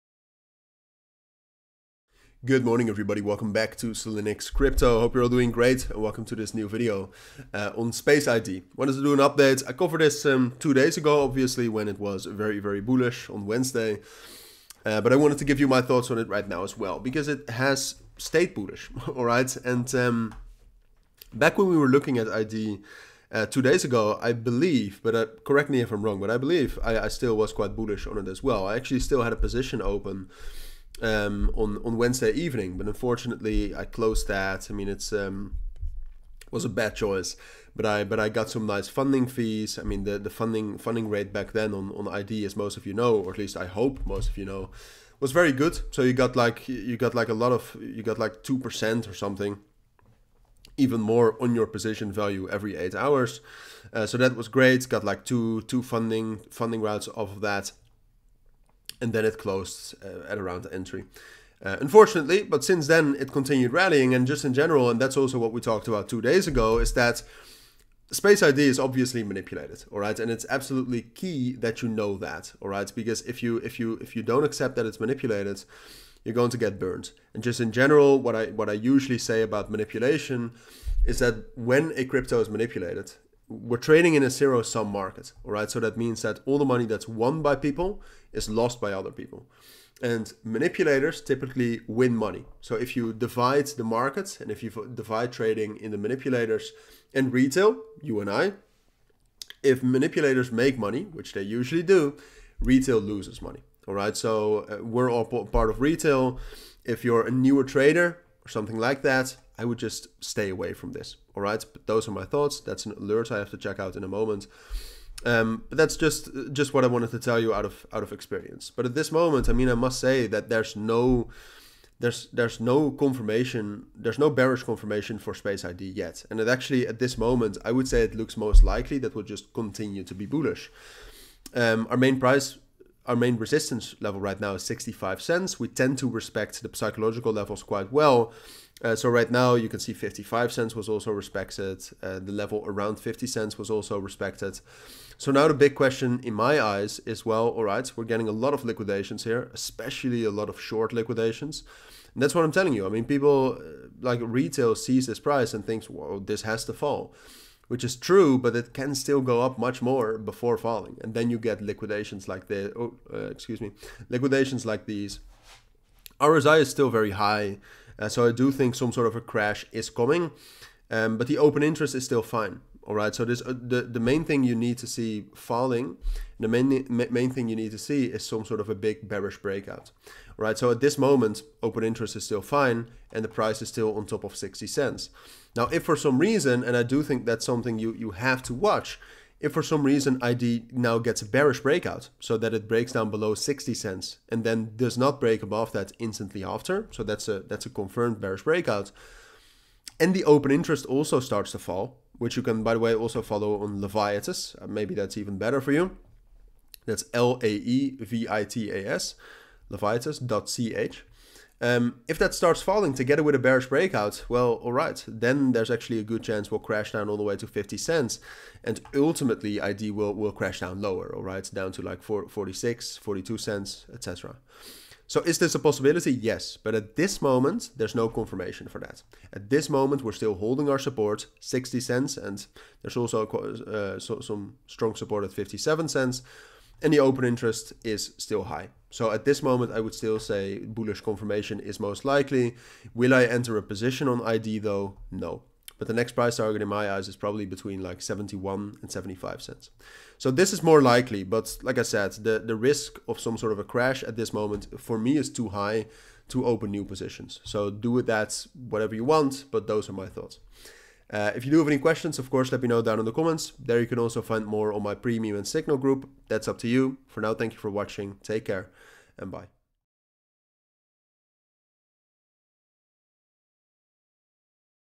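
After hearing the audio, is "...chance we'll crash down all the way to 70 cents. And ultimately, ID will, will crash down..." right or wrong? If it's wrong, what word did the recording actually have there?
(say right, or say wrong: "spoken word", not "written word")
wrong: "50", not "70".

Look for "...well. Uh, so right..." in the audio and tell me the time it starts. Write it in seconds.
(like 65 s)
137 s.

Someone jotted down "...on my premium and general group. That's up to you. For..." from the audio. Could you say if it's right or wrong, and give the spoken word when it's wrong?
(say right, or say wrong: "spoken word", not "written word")
wrong: "signal", not "general".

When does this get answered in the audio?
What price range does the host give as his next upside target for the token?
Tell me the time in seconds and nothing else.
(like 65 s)
247 s.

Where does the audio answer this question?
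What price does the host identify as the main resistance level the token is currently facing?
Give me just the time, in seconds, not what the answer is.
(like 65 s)
134 s.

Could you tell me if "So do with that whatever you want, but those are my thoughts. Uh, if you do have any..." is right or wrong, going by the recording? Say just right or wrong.
right.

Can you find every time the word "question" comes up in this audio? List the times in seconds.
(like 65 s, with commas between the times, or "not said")
145 s, 261 s.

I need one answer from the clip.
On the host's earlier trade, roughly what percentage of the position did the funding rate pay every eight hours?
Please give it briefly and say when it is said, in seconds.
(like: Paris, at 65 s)
2%, at 48 s.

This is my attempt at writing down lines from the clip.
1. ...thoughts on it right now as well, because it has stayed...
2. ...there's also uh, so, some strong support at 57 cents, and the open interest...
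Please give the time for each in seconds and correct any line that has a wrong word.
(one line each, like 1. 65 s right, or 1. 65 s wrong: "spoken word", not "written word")
1. 15 s right
2. 232 s right.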